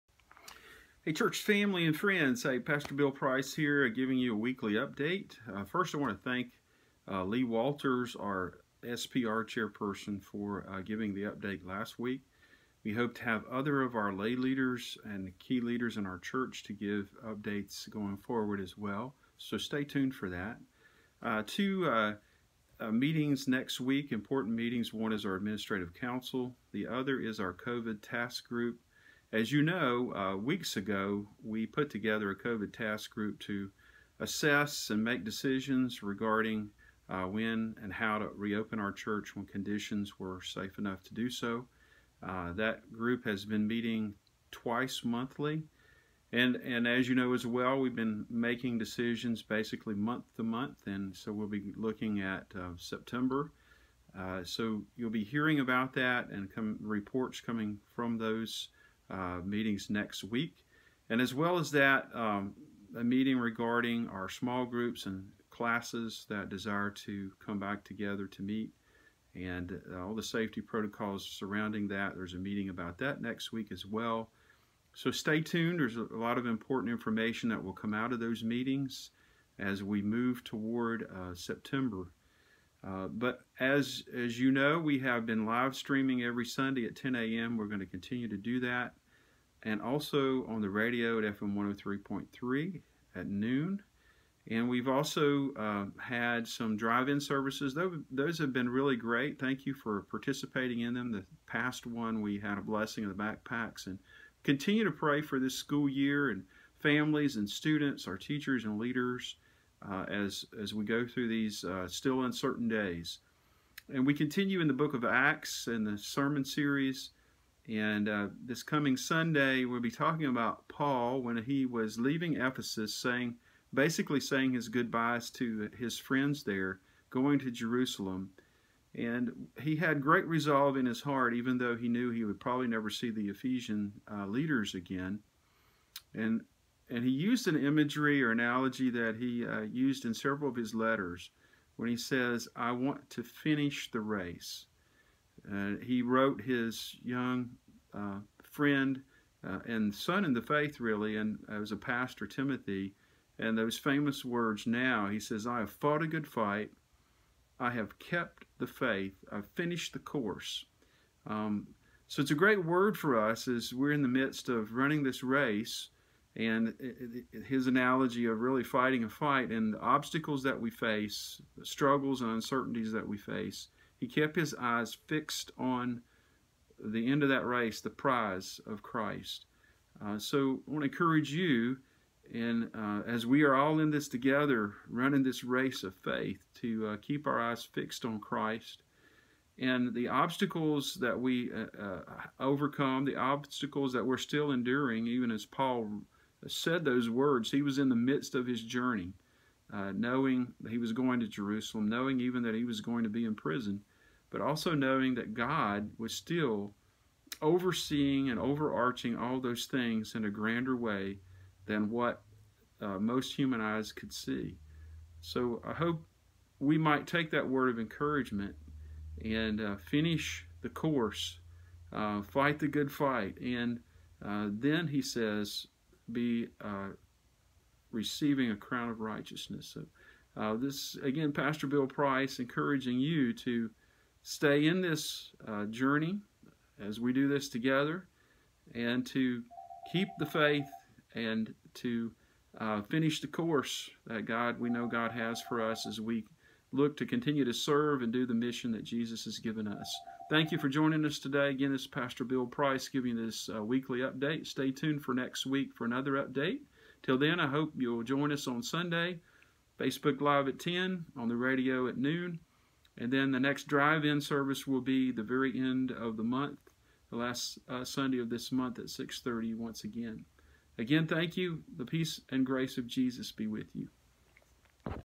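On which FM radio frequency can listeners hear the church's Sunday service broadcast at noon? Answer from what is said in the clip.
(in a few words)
103.3.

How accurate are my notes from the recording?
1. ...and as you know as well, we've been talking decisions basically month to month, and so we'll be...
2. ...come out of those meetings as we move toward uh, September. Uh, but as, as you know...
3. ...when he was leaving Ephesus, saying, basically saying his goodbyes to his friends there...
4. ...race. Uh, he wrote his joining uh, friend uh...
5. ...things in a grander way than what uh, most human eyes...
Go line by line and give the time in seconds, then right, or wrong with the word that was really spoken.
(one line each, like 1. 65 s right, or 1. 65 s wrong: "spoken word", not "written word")
1. 46 s wrong: "making", not "talking"
2. 77 s right
3. 121 s right
4. 144 s wrong: "young", not "joining"
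5. 209 s right.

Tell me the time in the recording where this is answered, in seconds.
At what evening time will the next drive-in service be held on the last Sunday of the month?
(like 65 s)
268 s.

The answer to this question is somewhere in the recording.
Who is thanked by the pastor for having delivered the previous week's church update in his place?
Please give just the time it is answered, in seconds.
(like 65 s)
7 s.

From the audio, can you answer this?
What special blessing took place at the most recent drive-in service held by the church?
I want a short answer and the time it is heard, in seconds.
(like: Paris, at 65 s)
Blessing of the backpacks, at 102 s.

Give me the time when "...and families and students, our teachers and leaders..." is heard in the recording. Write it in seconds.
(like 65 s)
106 s.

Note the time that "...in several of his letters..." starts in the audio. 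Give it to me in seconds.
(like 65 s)
140 s.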